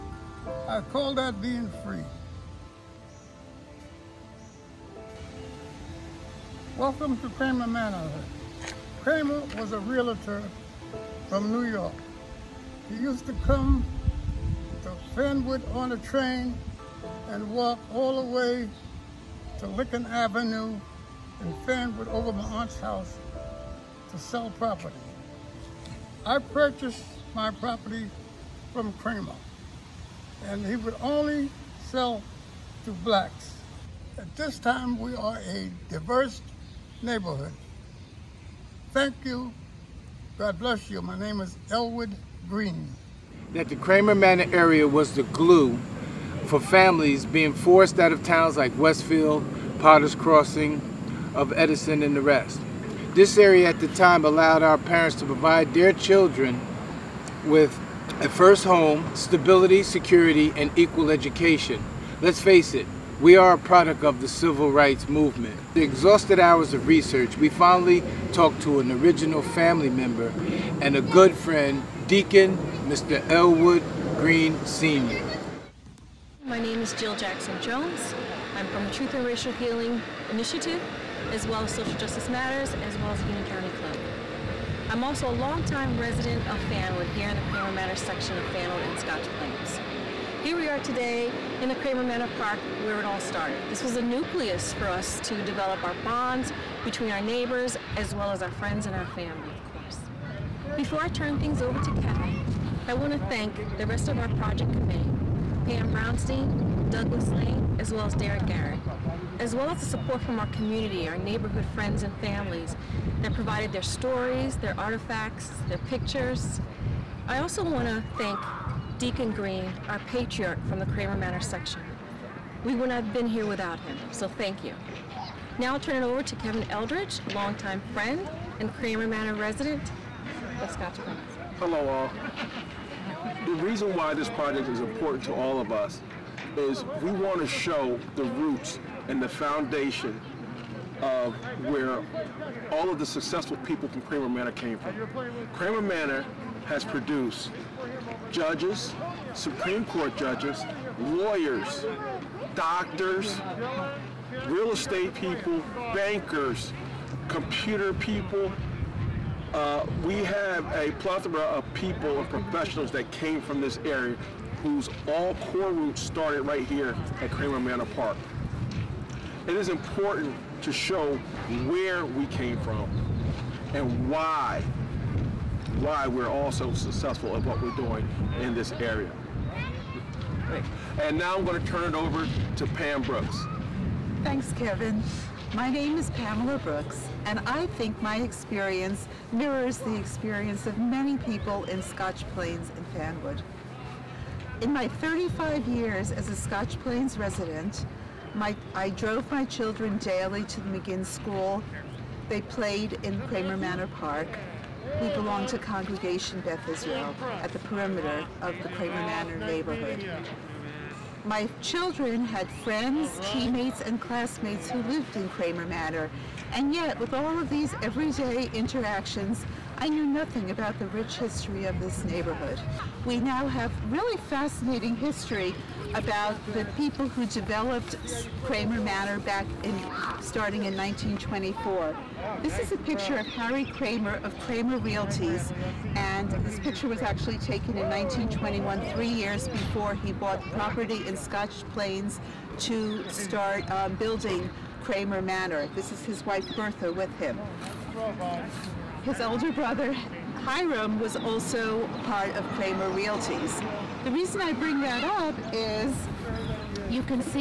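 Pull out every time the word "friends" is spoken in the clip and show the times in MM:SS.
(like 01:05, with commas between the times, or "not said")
01:11, 01:38, 01:51, 02:07, 03:32.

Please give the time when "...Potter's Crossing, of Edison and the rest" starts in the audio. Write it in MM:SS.
00:49.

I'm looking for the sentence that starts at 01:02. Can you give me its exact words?
Let's face it, we are a product of the civil rights movement.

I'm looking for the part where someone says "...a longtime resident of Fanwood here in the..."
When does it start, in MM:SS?
01:25.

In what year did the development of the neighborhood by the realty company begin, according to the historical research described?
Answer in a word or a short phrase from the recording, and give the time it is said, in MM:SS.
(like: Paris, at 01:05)
1924, at 03:50.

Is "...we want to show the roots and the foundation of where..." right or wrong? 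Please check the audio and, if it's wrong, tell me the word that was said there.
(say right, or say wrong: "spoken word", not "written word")
right.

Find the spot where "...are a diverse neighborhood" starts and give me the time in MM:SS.
00:35.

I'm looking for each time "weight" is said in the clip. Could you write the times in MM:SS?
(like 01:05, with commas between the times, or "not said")
not said.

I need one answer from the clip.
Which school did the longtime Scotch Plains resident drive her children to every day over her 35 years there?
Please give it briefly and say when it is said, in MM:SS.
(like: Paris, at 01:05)
McGinn School, at 03:20.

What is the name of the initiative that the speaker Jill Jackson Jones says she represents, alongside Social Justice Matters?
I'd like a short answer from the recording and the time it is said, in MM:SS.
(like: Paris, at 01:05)
Truth and Racial Healing Initiative, at 01:18.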